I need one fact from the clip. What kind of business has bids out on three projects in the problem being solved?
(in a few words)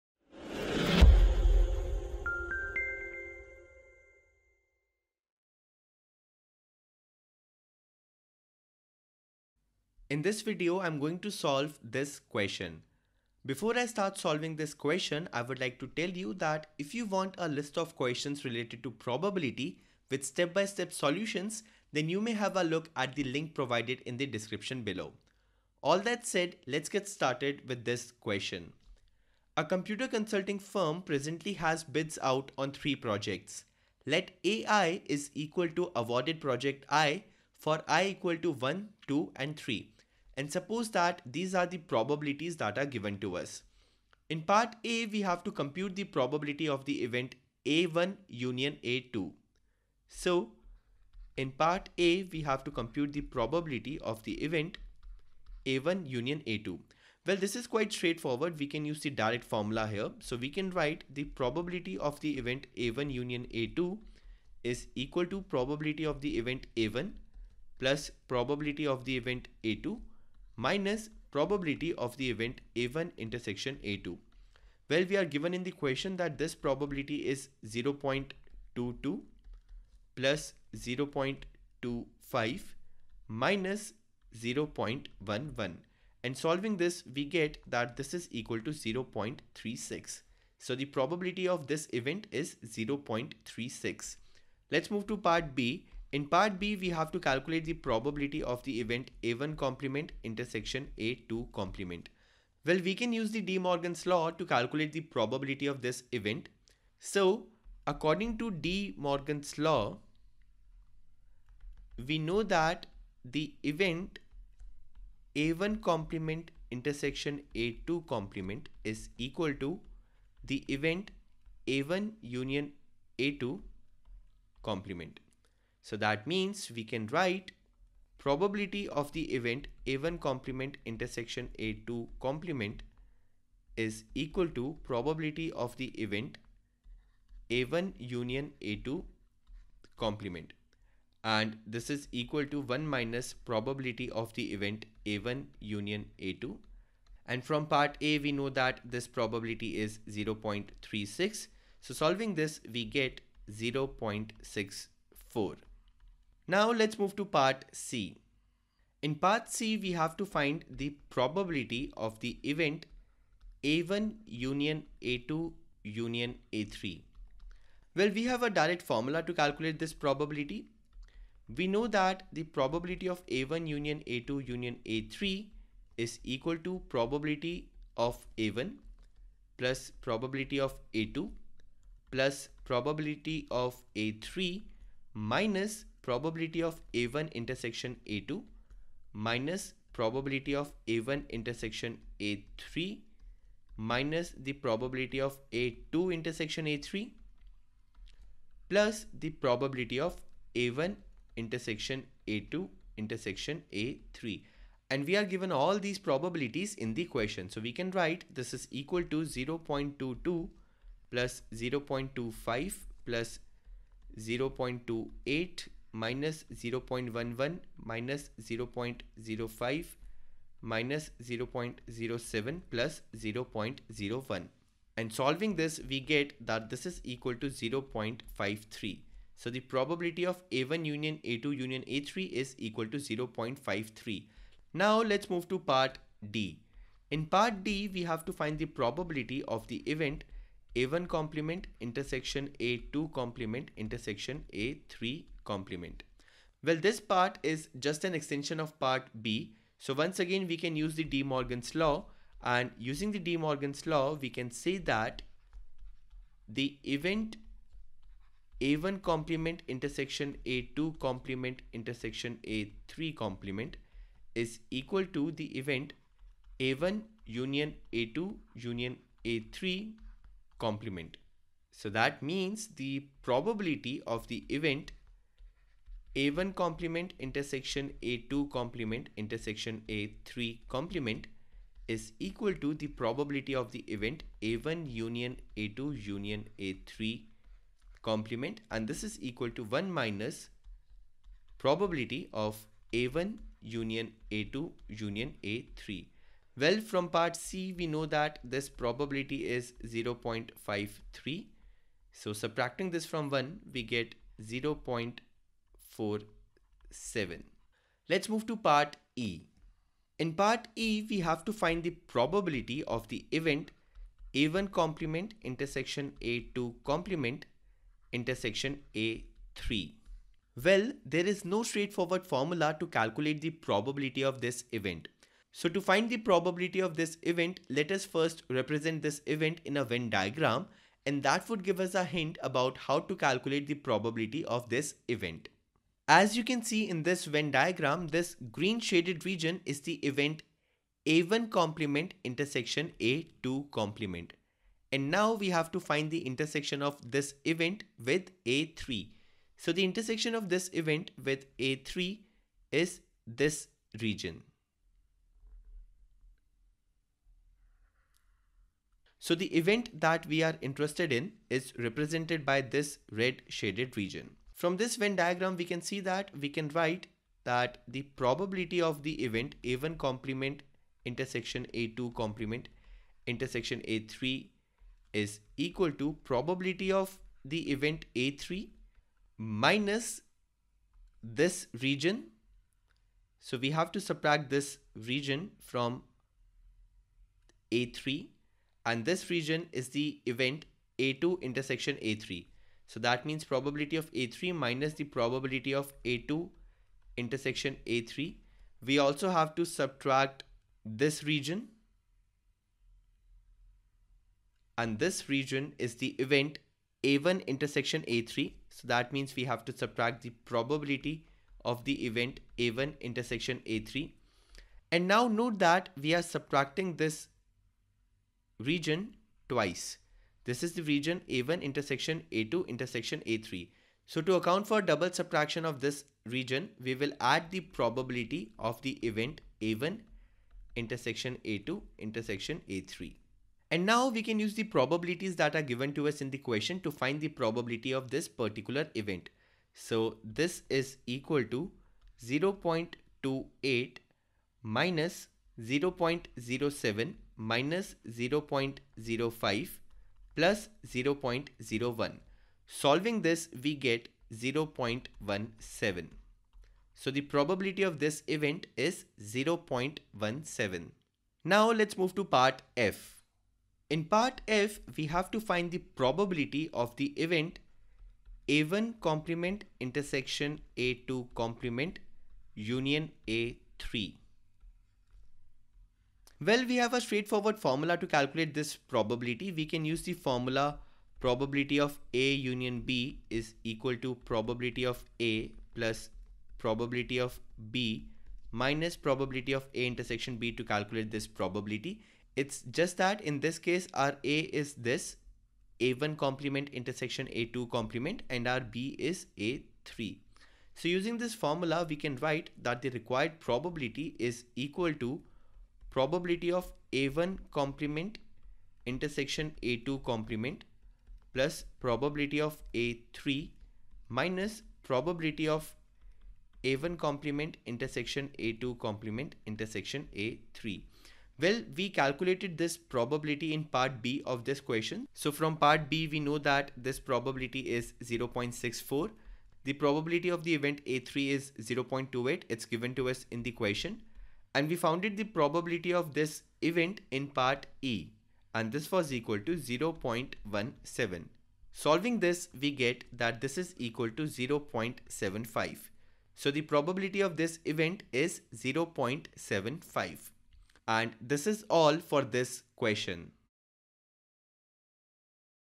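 computer consulting firm.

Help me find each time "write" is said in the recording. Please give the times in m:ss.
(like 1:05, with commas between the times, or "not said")
1:00, 2:07, 3:27, 6:06, 8:22.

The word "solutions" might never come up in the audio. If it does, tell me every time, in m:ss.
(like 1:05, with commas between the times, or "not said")
0:20.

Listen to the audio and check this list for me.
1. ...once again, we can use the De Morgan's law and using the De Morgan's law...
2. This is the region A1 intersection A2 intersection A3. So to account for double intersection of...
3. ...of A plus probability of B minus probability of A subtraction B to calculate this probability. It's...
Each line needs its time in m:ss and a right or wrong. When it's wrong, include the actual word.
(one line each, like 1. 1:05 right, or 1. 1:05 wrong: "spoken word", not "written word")
1. 4:09 right
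2. 7:00 wrong: "subtraction", not "intersection"
3. 8:04 wrong: "intersection", not "subtraction".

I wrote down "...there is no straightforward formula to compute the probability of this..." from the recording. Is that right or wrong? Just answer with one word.
wrong.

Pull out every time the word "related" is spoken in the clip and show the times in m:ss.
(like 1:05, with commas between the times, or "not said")
0:18.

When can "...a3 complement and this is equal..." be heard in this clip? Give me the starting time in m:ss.
4:46.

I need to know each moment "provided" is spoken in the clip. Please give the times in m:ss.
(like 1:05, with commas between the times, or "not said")
0:23.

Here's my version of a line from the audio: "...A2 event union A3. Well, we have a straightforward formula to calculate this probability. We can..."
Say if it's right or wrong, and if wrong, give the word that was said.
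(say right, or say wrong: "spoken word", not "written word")
wrong: "complement", not "event".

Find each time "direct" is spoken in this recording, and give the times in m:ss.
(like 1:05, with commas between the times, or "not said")
0:59, 2:48.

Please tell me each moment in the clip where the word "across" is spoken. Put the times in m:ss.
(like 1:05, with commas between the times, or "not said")
not said.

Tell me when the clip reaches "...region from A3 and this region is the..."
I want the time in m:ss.
6:24.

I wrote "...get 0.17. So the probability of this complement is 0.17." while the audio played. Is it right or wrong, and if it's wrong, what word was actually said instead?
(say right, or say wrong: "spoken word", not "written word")
wrong: "event", not "complement".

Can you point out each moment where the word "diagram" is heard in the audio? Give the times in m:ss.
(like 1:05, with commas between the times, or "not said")
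5:30, 5:37, 6:05.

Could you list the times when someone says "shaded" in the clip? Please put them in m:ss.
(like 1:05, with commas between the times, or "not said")
5:38, 6:03.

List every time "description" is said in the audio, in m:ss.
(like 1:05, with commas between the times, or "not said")
0:24.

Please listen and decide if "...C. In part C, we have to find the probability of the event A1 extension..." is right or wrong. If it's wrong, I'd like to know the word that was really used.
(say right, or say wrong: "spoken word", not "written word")
wrong: "union", not "extension".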